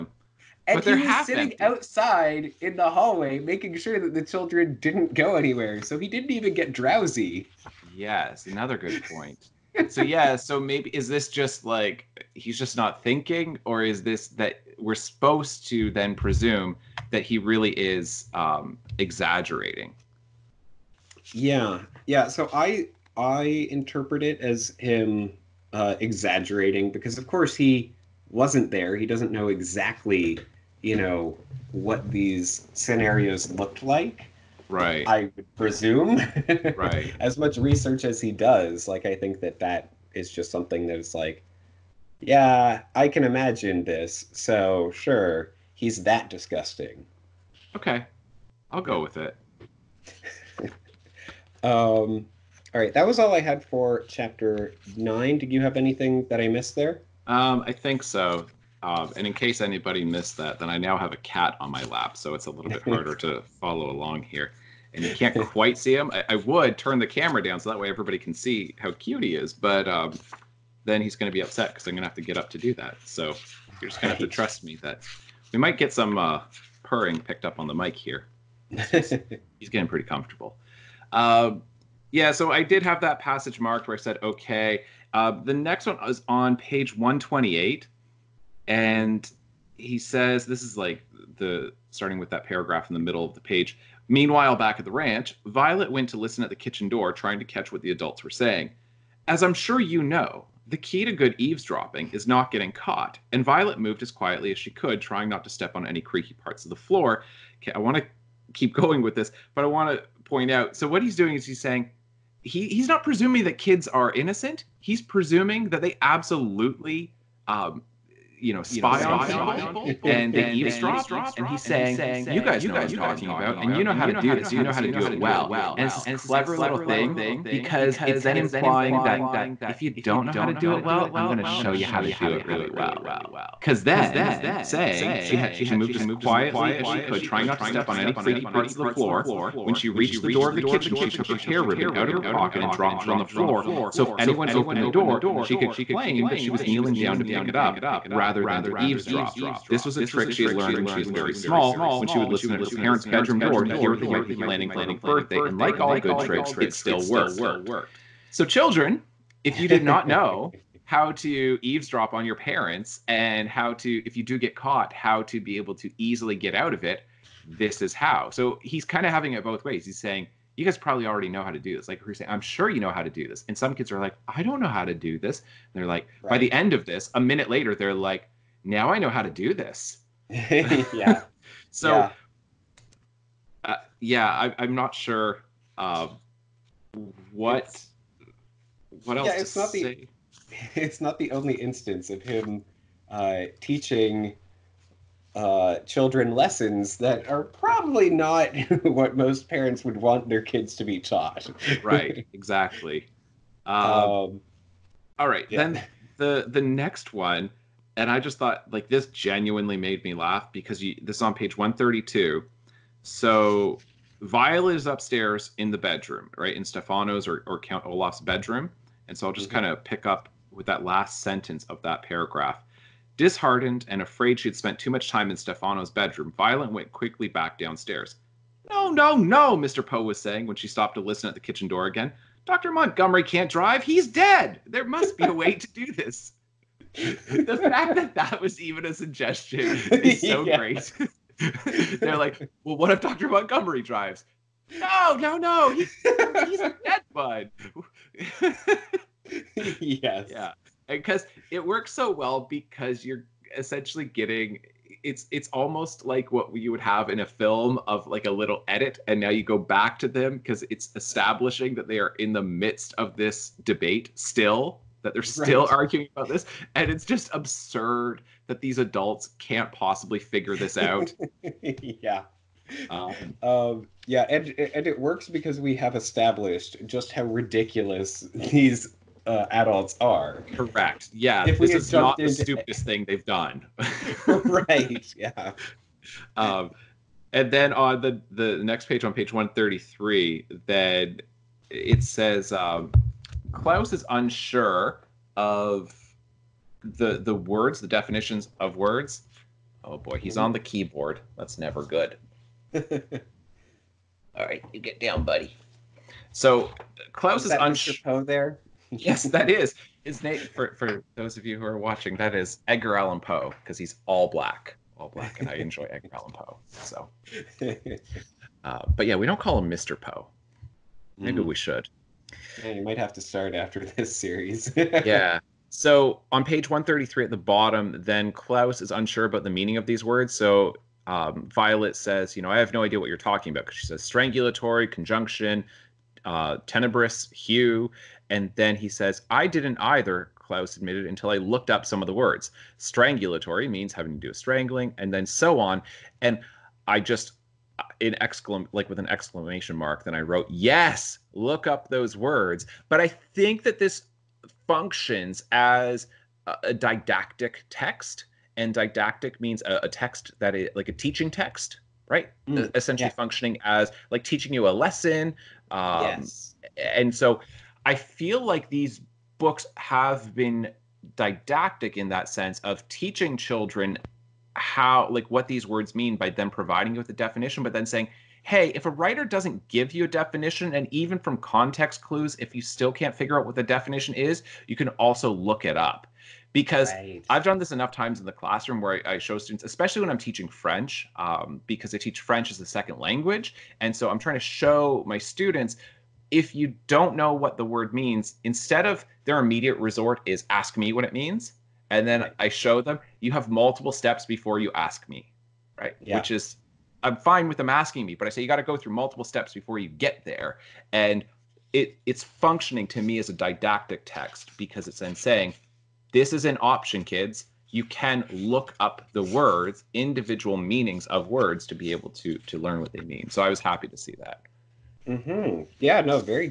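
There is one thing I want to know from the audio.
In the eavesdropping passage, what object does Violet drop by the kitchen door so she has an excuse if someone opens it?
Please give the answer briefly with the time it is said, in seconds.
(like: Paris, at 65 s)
Her hair ribbon, at 141 s.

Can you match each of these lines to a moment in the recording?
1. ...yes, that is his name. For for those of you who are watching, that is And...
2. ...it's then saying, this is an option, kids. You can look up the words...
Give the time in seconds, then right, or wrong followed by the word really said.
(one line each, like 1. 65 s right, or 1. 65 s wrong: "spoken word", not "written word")
1. 308 s wrong: "Edgar", not "And"
2. 414 s right.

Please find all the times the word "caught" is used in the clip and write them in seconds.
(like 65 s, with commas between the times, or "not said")
102 s, 164 s.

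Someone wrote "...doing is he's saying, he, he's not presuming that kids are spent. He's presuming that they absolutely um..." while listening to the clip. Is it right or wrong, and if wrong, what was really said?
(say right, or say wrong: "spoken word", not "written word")
wrong: "innocent", not "spent".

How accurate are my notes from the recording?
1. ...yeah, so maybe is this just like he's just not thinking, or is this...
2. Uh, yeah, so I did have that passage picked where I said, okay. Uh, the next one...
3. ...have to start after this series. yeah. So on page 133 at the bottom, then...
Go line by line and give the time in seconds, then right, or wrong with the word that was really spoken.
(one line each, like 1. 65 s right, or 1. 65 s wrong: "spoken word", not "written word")
1. 10 s right
2. 81 s wrong: "marked", not "picked"
3. 322 s right.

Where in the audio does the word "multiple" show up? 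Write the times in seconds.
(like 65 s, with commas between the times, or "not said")
403 s, 408 s.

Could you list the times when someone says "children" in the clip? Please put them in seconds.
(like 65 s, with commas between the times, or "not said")
4 s, 158 s, 195 s, 373 s.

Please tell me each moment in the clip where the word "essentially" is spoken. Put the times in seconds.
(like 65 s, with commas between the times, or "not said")
253 s, 362 s.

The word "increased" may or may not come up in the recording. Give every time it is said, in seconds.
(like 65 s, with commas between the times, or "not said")
not said.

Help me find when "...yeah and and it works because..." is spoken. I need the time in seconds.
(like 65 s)
274 s.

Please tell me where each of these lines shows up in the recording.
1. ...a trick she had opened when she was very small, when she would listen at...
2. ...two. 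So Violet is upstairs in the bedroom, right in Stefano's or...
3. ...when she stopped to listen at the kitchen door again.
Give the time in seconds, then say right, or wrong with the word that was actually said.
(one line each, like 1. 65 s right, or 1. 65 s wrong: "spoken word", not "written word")
1. 149 s wrong: "learned", not "opened"
2. 212 s right
3. 230 s right.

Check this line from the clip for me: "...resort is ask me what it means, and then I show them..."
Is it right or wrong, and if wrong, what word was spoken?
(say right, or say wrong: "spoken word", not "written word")
right.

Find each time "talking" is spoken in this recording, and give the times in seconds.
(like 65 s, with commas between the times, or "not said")
122 s, 333 s.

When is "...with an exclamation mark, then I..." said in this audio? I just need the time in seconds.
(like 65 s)
348 s.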